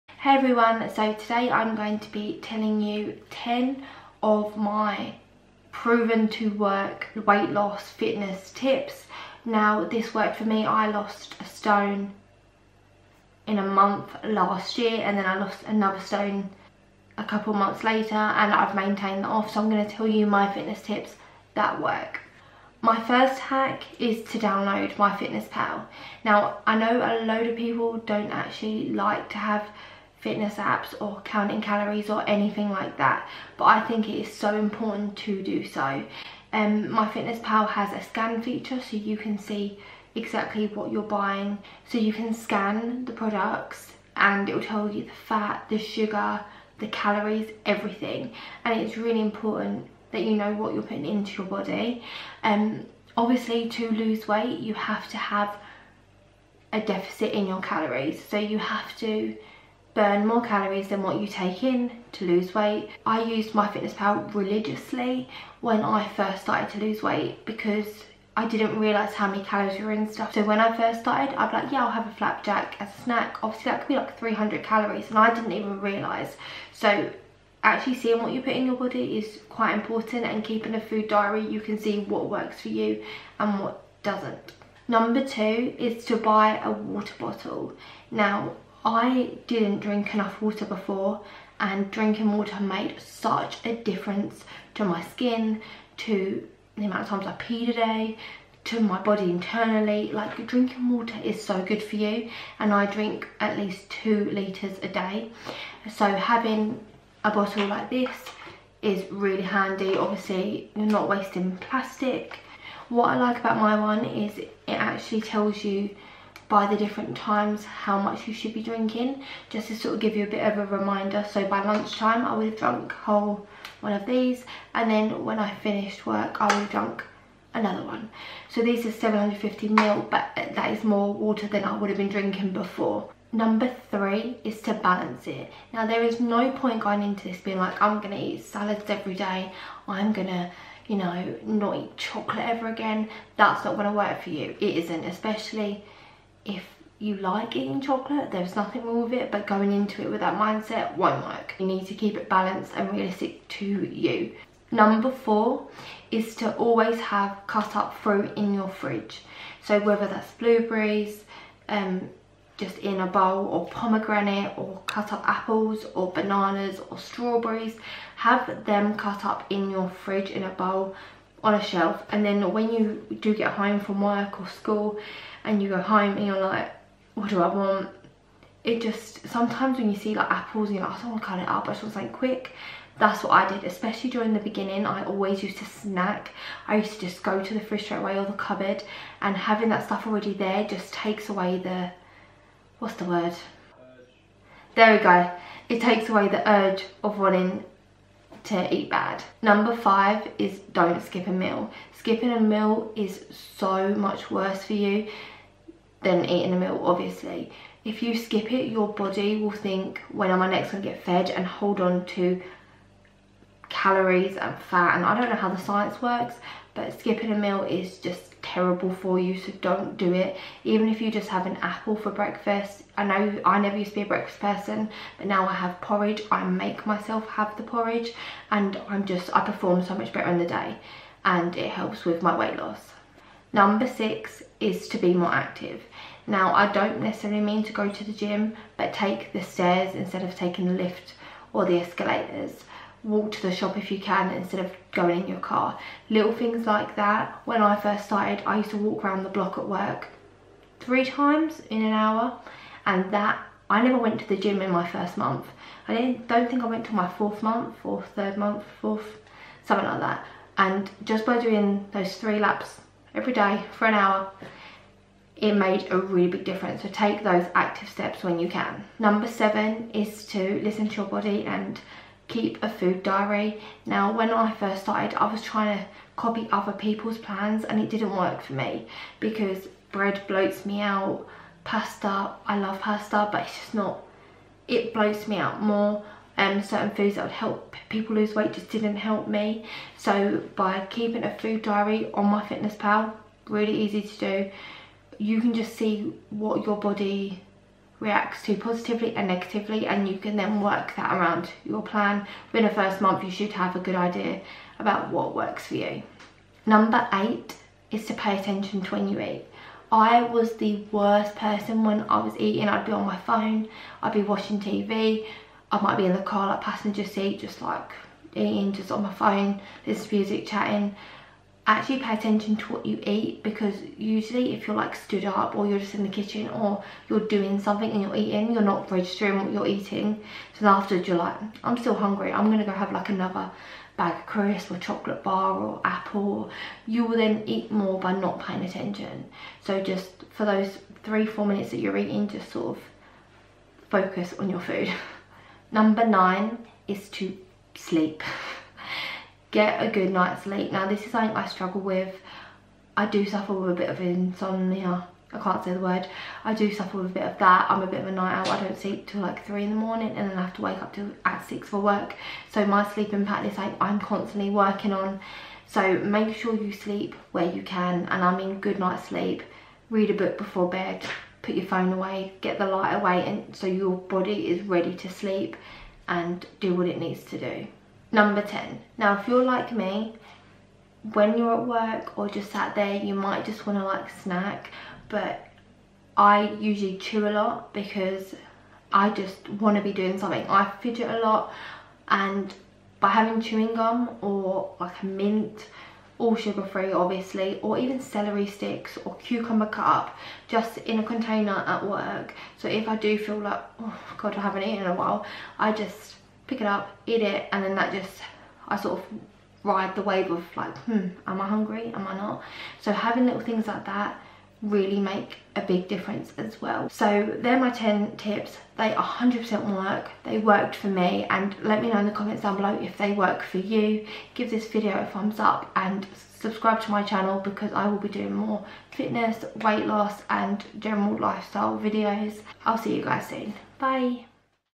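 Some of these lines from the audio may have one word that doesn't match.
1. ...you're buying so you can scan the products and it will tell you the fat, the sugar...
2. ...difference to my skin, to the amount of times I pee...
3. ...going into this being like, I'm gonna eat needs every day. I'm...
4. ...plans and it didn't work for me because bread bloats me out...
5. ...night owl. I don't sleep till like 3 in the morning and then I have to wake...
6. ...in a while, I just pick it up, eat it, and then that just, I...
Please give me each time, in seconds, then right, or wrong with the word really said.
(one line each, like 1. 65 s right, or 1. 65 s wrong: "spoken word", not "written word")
1. 40 s right
2. 93 s right
3. 136 s wrong: "salads", not "needs"
4. 277 s right
5. 358 s right
6. 404 s right.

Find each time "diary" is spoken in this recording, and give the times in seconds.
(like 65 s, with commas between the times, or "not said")
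81 s, 273 s, 291 s.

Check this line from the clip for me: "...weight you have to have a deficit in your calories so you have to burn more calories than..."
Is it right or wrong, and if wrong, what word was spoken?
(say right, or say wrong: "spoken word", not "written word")
right.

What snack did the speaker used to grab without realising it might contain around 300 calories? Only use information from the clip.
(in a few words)
flapjack.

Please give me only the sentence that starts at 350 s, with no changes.
Now this is something I struggle with.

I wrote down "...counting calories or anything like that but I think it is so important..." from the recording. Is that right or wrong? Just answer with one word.
right.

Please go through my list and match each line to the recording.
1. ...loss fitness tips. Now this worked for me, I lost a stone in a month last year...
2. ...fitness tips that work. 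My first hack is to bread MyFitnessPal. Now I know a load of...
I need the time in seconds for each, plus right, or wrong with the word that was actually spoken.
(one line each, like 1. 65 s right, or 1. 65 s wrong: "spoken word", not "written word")
1. 7 s right
2. 20 s wrong: "download", not "bread".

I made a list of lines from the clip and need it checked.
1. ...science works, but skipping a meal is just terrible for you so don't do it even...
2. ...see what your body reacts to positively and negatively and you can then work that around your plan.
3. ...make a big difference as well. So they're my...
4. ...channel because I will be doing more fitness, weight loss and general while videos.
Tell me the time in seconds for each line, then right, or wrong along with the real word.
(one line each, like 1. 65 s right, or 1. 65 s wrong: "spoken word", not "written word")
1. 215 s right
2. 295 s right
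3. 414 s right
4. 427 s wrong: "lifestyle", not "while".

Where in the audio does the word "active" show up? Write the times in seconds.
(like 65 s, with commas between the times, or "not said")
235 s, 267 s.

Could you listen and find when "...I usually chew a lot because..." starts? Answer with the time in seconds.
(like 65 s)
386 s.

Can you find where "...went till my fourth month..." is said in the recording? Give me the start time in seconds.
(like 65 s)
256 s.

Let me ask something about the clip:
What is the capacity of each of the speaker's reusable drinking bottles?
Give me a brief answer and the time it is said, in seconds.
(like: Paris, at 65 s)
750 ml, at 128 s.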